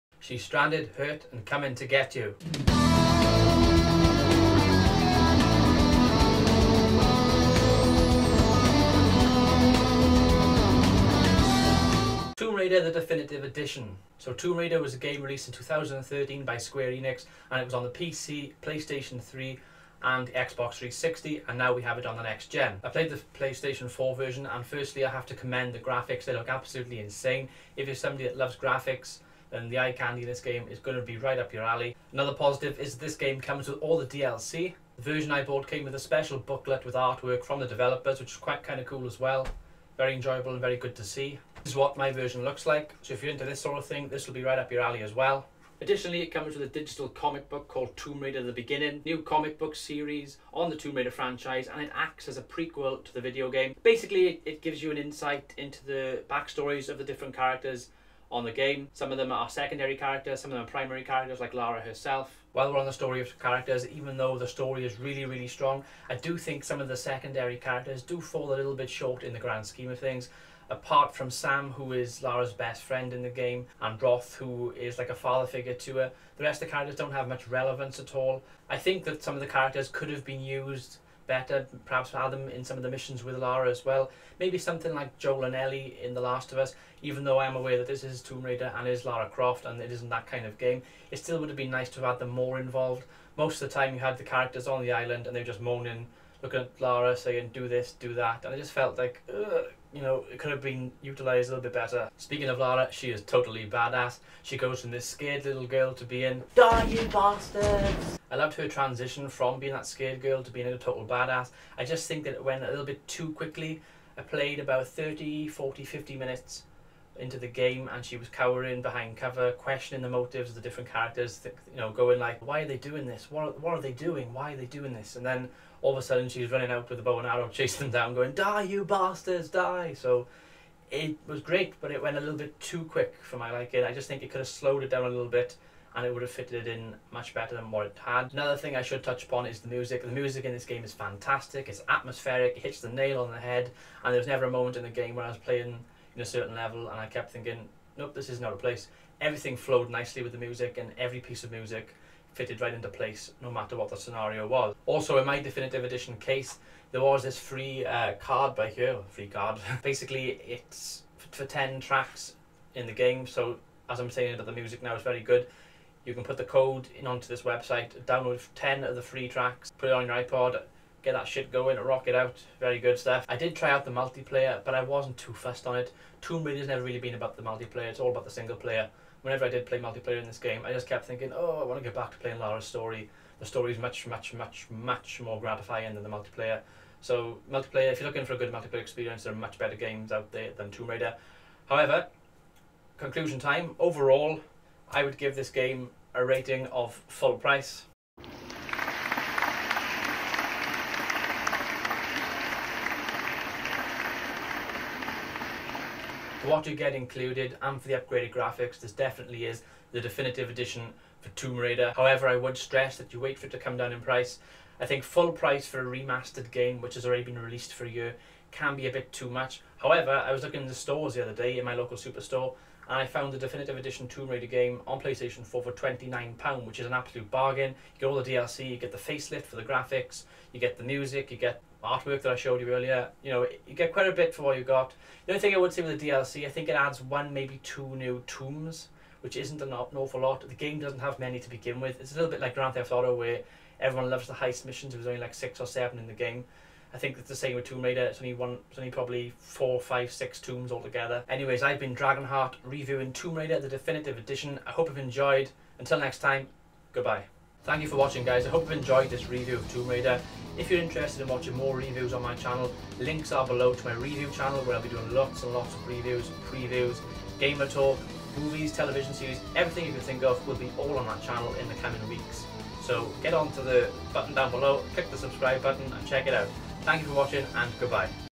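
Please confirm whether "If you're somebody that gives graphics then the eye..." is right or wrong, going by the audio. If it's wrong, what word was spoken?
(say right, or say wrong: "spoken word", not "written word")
wrong: "loves", not "gives".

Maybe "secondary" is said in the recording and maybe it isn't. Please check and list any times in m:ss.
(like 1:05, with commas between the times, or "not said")
0:59, 1:06.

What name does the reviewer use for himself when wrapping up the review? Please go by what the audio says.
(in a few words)
Dragonheart.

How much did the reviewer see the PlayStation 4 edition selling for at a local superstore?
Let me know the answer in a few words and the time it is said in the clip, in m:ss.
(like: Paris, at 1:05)
£29, at 3:45.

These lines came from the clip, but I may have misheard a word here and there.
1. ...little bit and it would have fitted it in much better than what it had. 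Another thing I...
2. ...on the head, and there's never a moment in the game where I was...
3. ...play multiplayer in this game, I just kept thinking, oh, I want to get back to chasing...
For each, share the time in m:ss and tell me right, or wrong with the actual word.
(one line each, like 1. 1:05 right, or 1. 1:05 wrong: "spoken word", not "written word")
1. 2:15 right
2. 2:23 right
3. 2:59 wrong: "playing", not "chasing".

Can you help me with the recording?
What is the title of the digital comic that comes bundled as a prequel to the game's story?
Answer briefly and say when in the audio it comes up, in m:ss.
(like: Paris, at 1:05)
Tomb Raider The Beginning, at 0:47.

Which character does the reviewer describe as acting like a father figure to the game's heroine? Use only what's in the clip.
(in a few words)
Roth.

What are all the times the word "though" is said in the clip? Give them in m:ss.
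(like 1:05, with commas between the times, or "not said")
1:04, 1:27.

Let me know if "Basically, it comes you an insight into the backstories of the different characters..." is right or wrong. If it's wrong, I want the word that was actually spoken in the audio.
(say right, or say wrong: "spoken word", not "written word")
wrong: "gives", not "comes".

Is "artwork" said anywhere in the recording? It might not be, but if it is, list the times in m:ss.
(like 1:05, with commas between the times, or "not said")
0:36, 3:51.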